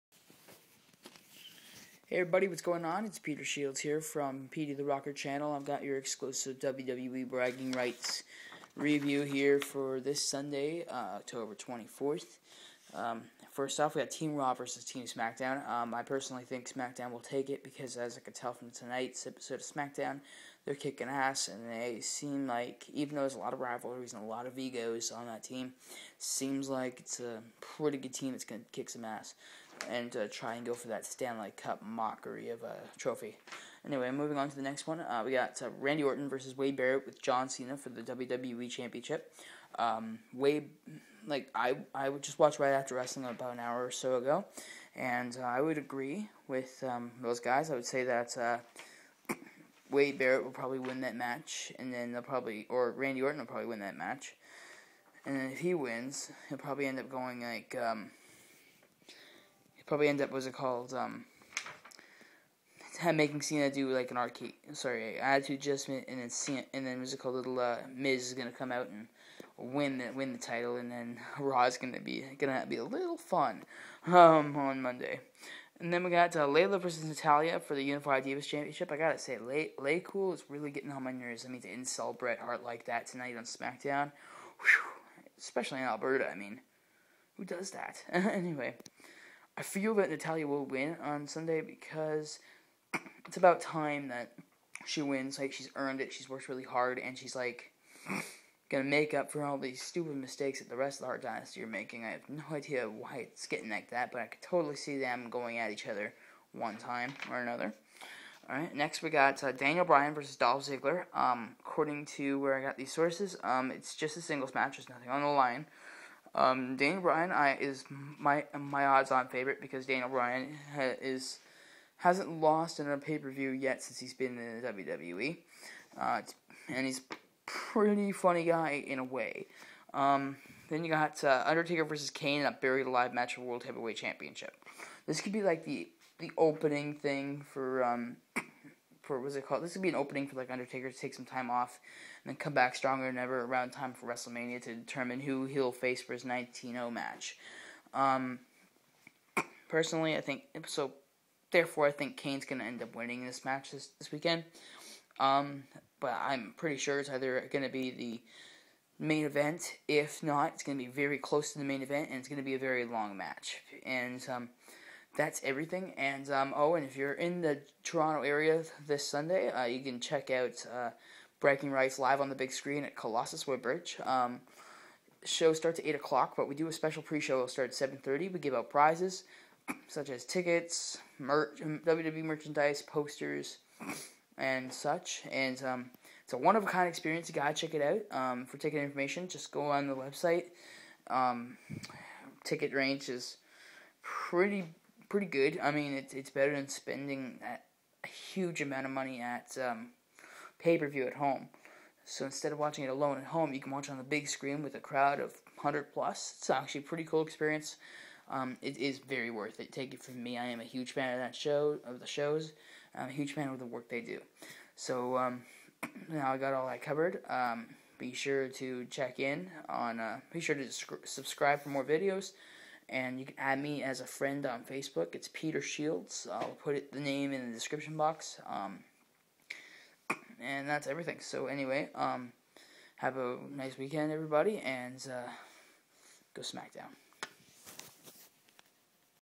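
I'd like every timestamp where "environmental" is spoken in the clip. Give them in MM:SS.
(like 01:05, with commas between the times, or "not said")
not said.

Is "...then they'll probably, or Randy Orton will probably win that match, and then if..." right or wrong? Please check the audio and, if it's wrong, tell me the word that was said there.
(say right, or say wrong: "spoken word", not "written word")
right.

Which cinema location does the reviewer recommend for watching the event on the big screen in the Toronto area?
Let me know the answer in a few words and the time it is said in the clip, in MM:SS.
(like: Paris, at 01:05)
Colossus Woodbridge, at 02:52.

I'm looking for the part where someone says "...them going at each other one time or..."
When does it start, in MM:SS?
01:44.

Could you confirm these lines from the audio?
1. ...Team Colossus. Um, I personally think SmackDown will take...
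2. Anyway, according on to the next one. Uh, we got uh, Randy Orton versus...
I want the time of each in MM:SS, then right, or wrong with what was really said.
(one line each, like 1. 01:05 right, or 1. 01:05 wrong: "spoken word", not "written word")
1. 00:14 wrong: "SmackDown", not "Colossus"
2. 00:33 wrong: "moving", not "according".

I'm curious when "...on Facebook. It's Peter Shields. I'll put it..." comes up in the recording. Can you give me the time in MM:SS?
03:44.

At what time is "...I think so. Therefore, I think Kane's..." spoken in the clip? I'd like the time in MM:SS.
02:30.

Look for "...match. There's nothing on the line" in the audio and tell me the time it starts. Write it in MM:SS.
01:54.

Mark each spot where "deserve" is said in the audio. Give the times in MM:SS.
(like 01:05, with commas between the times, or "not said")
not said.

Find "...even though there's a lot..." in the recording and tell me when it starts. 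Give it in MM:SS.
00:22.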